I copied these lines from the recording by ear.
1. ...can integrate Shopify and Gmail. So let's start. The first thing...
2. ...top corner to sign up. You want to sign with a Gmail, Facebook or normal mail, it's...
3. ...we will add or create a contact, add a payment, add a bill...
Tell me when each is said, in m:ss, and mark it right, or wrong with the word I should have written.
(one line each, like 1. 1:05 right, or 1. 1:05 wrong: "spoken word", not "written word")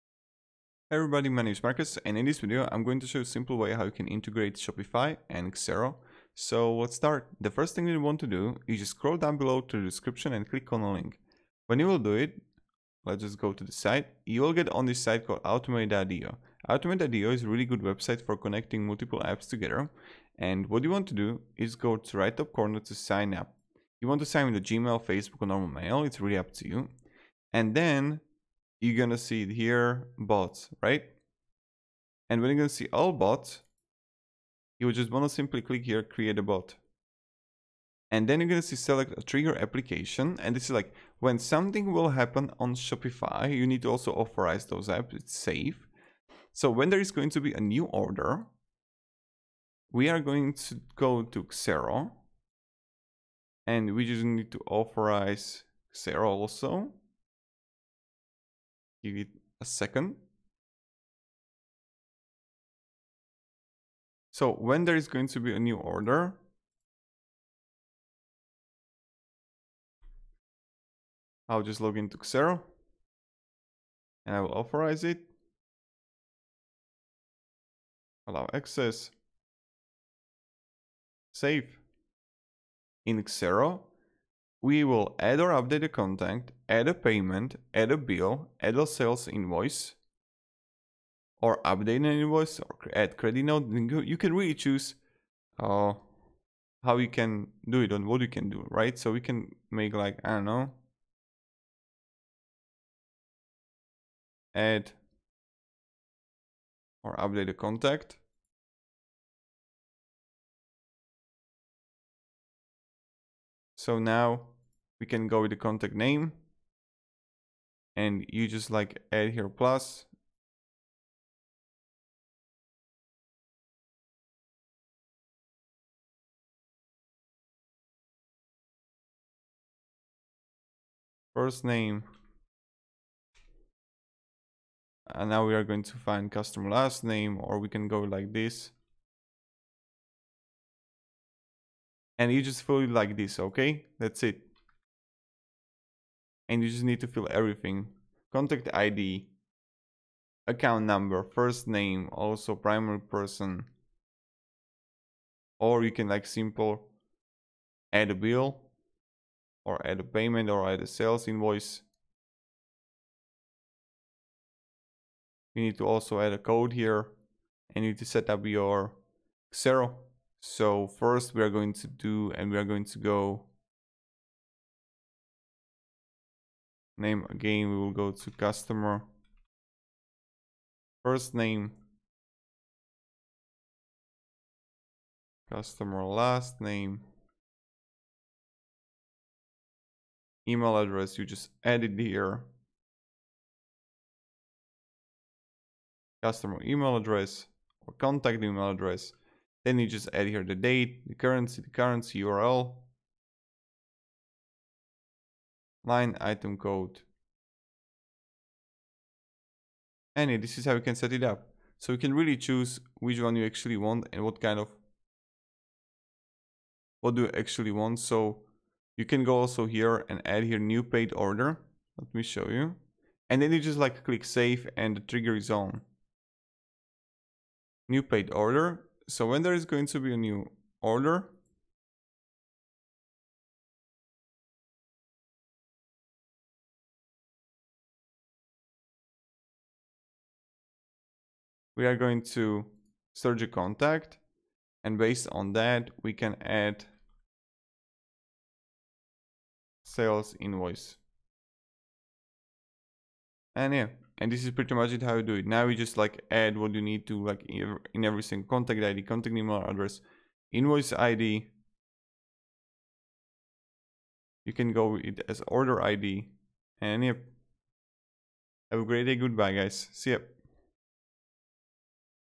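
1. 0:03 wrong: "Xero", not "Gmail"
2. 0:22 right
3. 1:24 wrong: "update", not "create".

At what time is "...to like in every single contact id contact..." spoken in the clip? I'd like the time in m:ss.
4:17.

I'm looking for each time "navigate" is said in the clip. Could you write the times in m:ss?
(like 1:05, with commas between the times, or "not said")
not said.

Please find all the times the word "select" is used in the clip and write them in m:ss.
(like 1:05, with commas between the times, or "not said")
0:38.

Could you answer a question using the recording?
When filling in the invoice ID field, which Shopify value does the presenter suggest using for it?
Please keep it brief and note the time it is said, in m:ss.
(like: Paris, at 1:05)
order id, at 4:25.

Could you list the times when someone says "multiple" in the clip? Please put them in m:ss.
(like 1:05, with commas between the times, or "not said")
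0:18.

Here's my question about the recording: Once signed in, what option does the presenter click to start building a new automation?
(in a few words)
create a bot.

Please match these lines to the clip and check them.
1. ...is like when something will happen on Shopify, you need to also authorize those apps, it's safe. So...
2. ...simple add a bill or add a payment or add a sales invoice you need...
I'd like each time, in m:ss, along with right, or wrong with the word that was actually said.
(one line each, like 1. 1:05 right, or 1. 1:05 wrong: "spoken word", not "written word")
1. 0:40 right
2. 2:36 right.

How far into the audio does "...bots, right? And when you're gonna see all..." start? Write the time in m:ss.
0:30.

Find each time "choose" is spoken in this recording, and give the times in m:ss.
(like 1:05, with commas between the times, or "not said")
1:34, 3:32.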